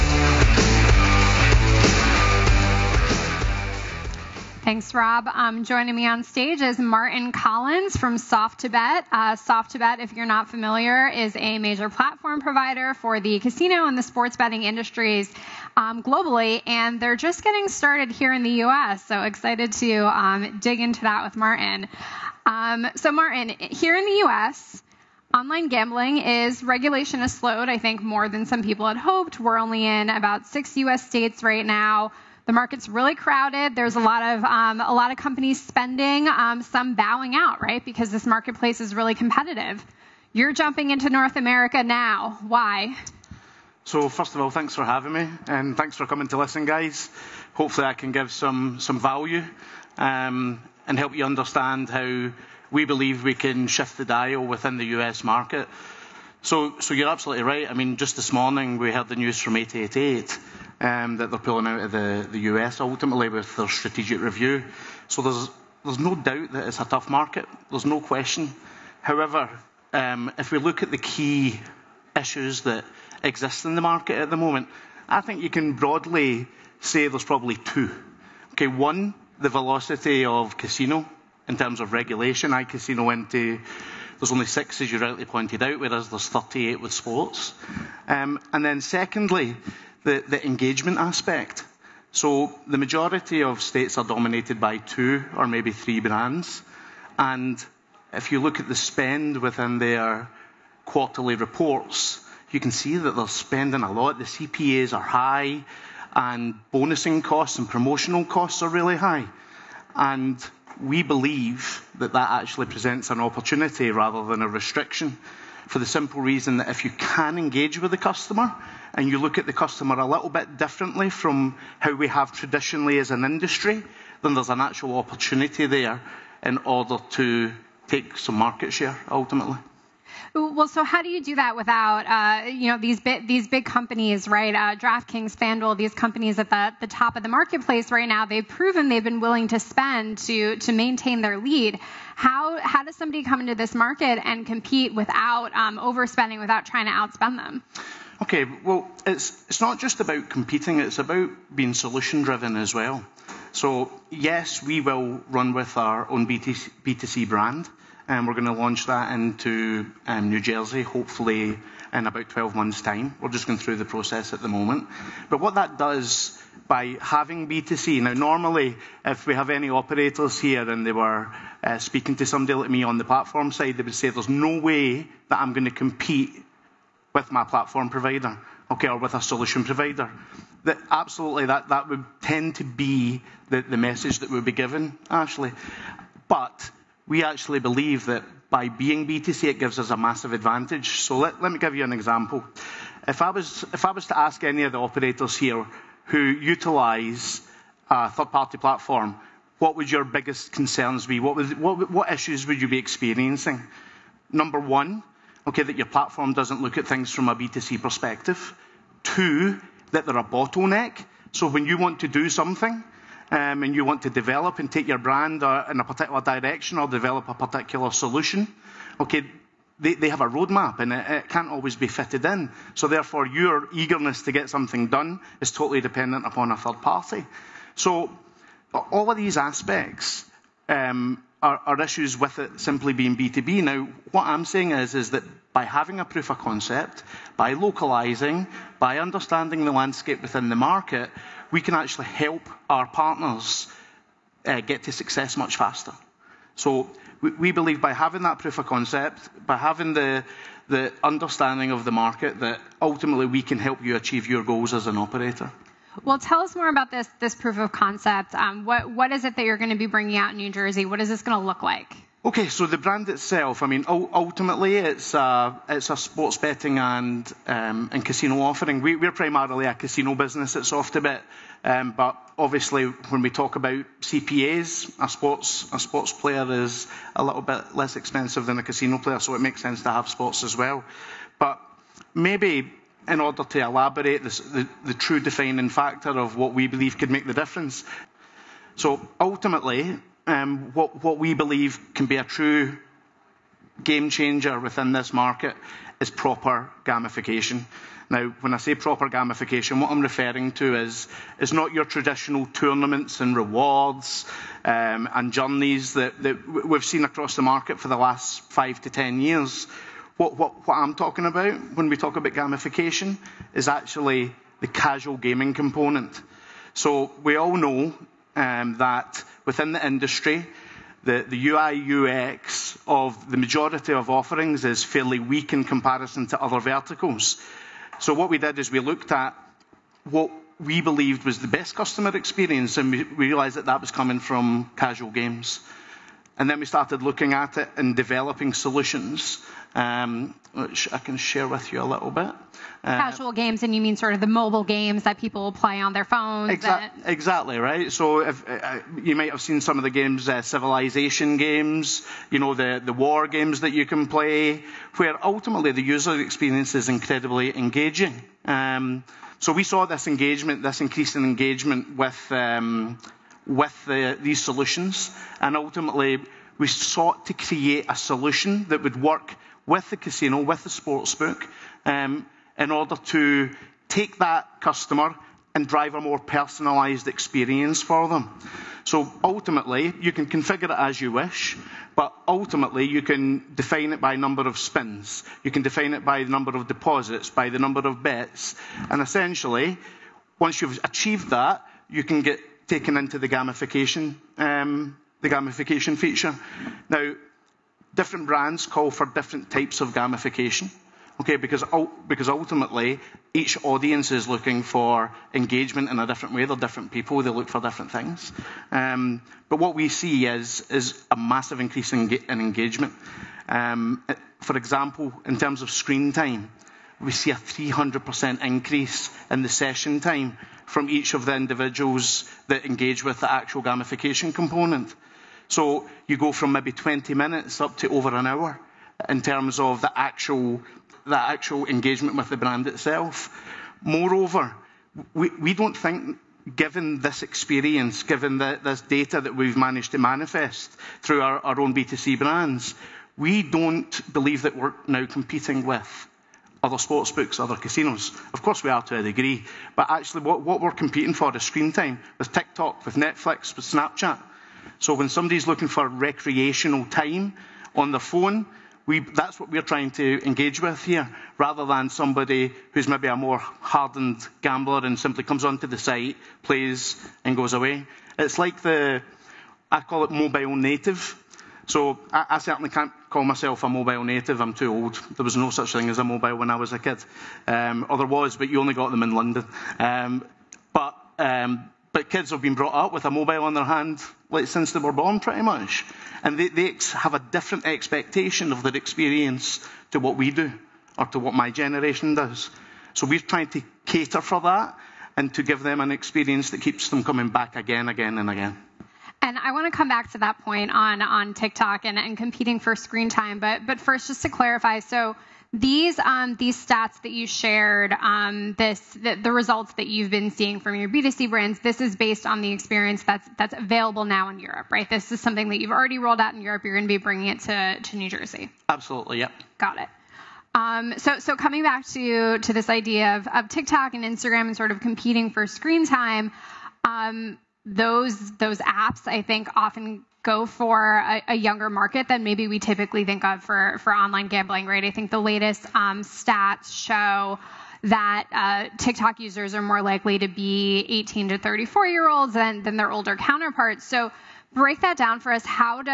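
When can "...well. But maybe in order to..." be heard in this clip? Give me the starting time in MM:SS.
04:40.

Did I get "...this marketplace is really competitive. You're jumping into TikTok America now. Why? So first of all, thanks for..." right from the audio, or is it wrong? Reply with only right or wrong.
wrong.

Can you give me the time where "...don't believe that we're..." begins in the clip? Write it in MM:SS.
07:23.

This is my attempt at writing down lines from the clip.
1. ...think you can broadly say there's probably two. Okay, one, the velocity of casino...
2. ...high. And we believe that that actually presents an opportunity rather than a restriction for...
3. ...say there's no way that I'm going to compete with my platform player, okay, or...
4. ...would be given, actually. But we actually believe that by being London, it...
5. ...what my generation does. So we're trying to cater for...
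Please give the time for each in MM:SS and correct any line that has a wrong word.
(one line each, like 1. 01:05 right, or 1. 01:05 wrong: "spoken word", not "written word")
1. 01:15 right
2. 01:48 right
3. 02:53 wrong: "provider", not "player"
4. 03:04 wrong: "BTC", not "London"
5. 08:11 right.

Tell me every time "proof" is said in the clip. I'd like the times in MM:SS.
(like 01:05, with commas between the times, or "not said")
03:56, 04:08, 04:17.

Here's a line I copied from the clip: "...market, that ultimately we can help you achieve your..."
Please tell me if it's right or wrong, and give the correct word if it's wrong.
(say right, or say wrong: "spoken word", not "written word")
right.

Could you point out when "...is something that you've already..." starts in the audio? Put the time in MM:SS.
08:35.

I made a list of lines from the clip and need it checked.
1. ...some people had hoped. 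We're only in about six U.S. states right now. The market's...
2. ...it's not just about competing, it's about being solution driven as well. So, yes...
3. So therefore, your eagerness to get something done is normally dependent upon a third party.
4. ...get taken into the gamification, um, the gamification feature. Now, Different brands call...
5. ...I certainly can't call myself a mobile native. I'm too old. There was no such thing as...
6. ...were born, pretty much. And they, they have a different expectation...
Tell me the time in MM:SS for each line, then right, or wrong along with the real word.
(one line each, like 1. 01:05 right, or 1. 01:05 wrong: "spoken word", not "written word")
1. 00:28 right
2. 02:29 right
3. 03:42 wrong: "totally", not "normally"
4. 06:32 right
5. 07:52 right
6. 08:04 right.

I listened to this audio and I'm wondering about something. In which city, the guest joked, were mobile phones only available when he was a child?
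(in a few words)
London.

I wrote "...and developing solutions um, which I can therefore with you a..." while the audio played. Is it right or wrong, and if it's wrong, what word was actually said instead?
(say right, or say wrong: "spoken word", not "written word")
wrong: "share", not "therefore".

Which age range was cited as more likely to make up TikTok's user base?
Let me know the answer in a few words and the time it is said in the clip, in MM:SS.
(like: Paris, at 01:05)
18 to 34, at 09:00.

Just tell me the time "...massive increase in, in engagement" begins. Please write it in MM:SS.
06:51.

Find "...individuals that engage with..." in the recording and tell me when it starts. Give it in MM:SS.
07:01.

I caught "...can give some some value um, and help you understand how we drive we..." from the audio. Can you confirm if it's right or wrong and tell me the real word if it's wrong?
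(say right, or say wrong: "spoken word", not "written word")
wrong: "believe", not "drive".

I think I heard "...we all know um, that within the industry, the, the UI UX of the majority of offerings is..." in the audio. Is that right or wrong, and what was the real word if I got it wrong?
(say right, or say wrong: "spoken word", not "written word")
right.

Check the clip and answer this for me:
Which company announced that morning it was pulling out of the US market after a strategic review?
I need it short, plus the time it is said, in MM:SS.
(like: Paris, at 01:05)
888, at 00:59.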